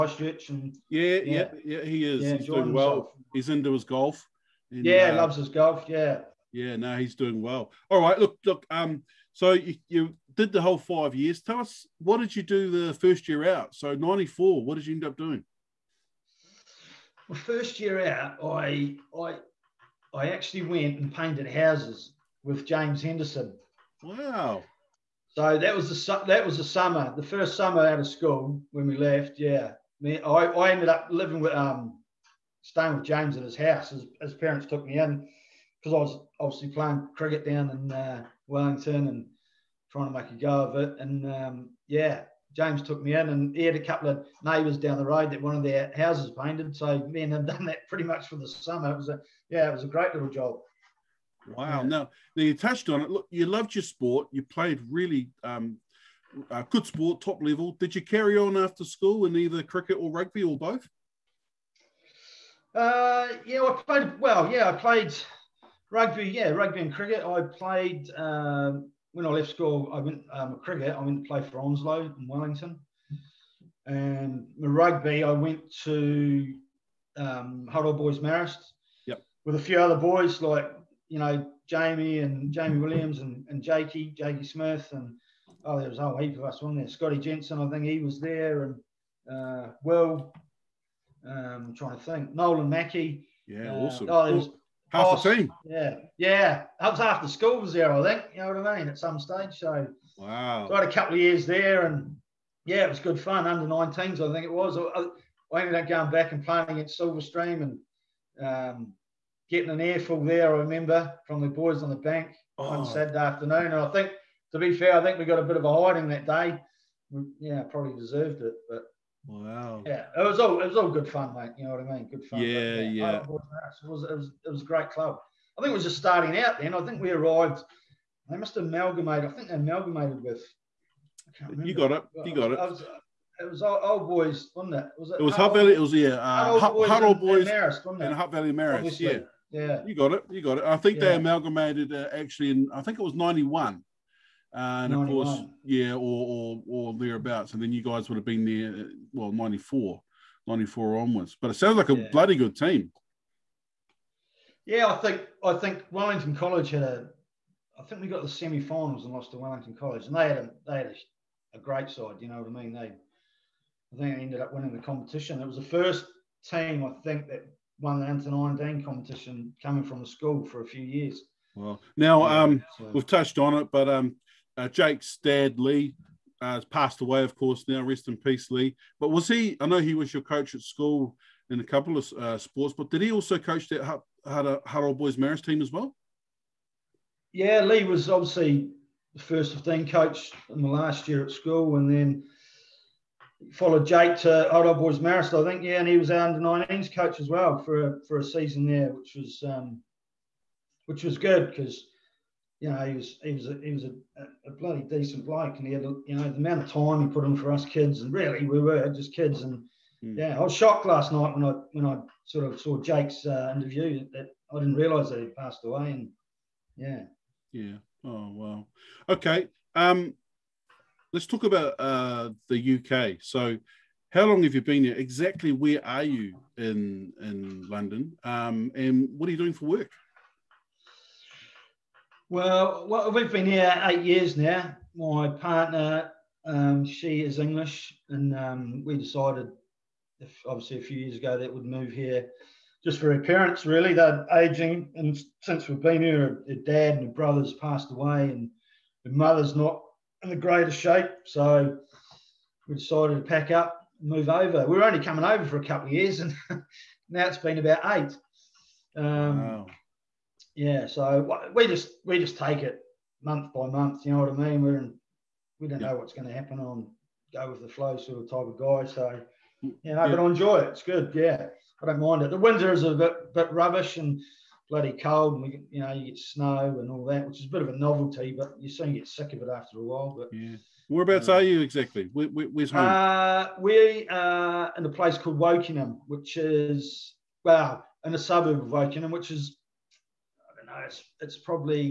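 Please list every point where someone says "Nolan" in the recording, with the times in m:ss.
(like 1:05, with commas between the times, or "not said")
1:32.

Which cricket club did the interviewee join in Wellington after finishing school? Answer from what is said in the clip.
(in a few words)
Onslow.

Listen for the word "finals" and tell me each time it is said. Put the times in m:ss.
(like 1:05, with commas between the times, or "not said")
2:38.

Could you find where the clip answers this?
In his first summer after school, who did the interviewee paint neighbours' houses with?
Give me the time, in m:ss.
0:22.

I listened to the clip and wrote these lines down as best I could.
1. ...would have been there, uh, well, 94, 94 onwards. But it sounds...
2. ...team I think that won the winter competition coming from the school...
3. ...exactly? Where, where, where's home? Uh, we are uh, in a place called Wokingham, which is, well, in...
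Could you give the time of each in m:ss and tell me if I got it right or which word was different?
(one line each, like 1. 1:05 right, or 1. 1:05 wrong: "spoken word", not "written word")
1. 2:28 right
2. 2:46 wrong: "under", not "winter"
3. 4:41 right.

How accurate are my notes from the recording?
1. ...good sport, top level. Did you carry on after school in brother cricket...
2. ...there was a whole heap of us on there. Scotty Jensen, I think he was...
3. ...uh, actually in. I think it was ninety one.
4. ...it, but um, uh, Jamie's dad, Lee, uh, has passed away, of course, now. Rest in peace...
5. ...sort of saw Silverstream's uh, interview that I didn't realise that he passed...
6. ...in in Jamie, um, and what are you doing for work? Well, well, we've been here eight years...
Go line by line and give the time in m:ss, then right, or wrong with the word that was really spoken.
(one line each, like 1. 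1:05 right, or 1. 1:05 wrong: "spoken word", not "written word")
1. 0:56 wrong: "either", not "brother"
2. 1:25 right
3. 2:21 right
4. 2:53 wrong: "Jake", not "Jamie"
5. 3:32 wrong: "Jake", not "Silverstream"
6. 3:46 wrong: "London", not "Jamie".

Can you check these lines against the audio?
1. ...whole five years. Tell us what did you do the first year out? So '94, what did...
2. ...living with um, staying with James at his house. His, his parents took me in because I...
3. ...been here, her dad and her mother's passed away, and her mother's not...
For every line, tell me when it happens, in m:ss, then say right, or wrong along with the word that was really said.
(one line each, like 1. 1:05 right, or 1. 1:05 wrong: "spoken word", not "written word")
1. 0:10 right
2. 0:31 right
3. 4:05 wrong: "brother", not "mother".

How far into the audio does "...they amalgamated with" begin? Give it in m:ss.
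2:09.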